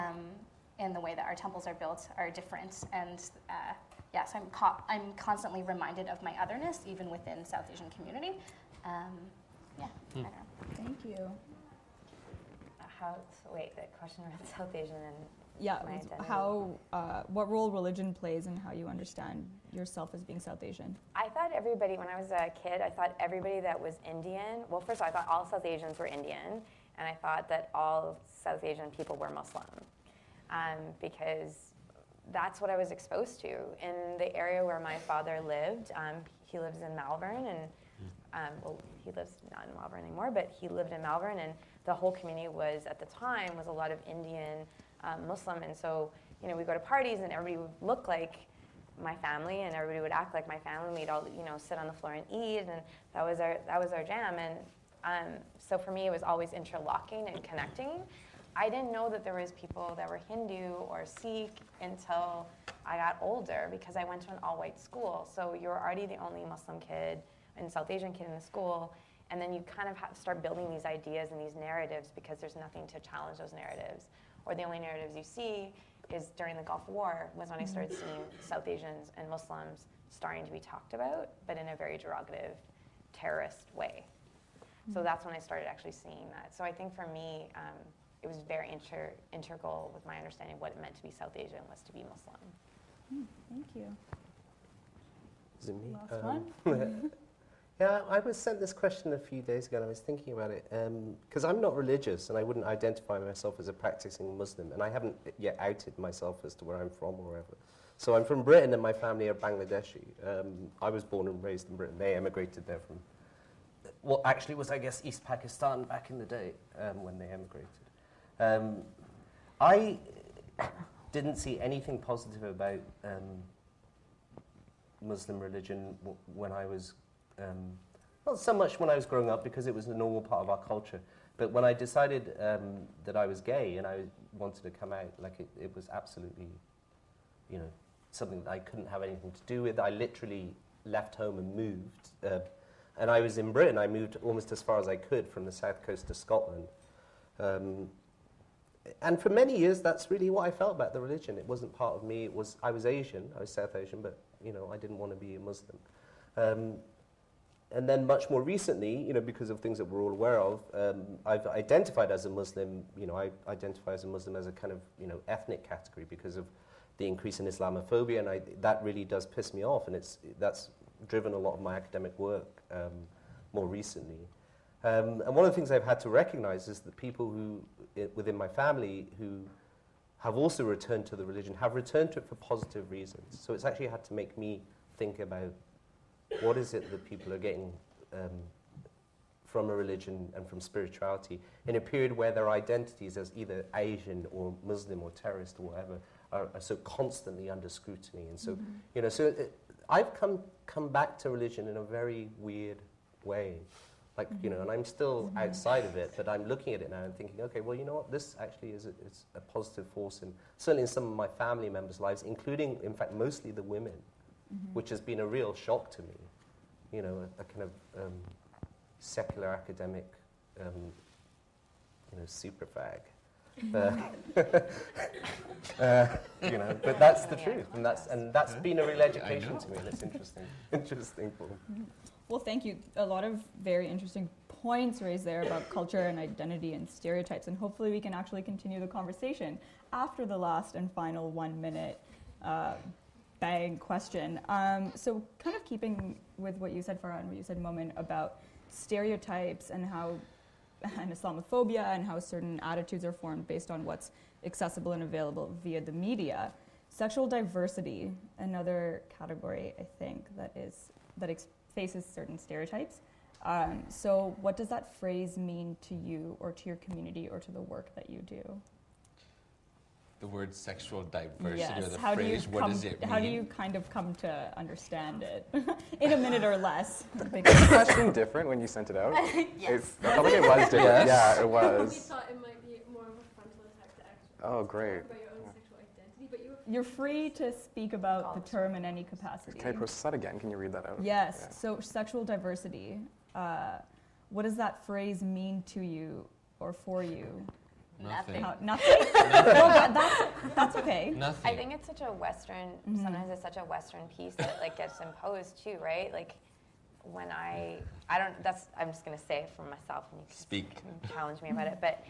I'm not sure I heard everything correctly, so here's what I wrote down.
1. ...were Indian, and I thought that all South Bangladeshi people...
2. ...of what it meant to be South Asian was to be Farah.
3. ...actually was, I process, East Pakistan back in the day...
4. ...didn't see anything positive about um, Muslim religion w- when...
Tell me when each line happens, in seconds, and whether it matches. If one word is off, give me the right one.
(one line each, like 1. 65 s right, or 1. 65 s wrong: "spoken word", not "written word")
1. 25 s wrong: "Asian", not "Bangladeshi"
2. 90 s wrong: "Muslim", not "Farah"
3. 114 s wrong: "guess", not "process"
4. 121 s right.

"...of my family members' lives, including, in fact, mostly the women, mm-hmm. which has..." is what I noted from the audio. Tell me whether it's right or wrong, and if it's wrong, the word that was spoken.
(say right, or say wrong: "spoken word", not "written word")
right.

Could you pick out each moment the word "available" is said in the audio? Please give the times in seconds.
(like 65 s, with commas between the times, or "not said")
255 s.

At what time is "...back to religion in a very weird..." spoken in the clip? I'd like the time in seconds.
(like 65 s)
200 s.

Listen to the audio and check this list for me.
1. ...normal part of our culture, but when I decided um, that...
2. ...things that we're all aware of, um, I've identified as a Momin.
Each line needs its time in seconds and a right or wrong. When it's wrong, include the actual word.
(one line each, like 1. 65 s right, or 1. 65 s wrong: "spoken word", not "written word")
1. 129 s right
2. 159 s wrong: "Muslim", not "Momin".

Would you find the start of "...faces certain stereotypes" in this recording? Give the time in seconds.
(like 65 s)
261 s.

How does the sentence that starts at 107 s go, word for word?
So I'm from Britain and my family are Bangladeshi.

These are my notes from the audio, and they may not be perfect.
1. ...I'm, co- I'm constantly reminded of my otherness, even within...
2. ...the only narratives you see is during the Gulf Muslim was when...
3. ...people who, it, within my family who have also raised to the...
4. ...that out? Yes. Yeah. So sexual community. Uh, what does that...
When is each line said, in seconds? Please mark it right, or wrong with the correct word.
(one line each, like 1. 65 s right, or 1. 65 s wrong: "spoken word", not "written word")
1. 4 s right
2. 74 s wrong: "War", not "Muslim"
3. 176 s wrong: "returned", not "raised"
4. 290 s wrong: "diversity", not "community".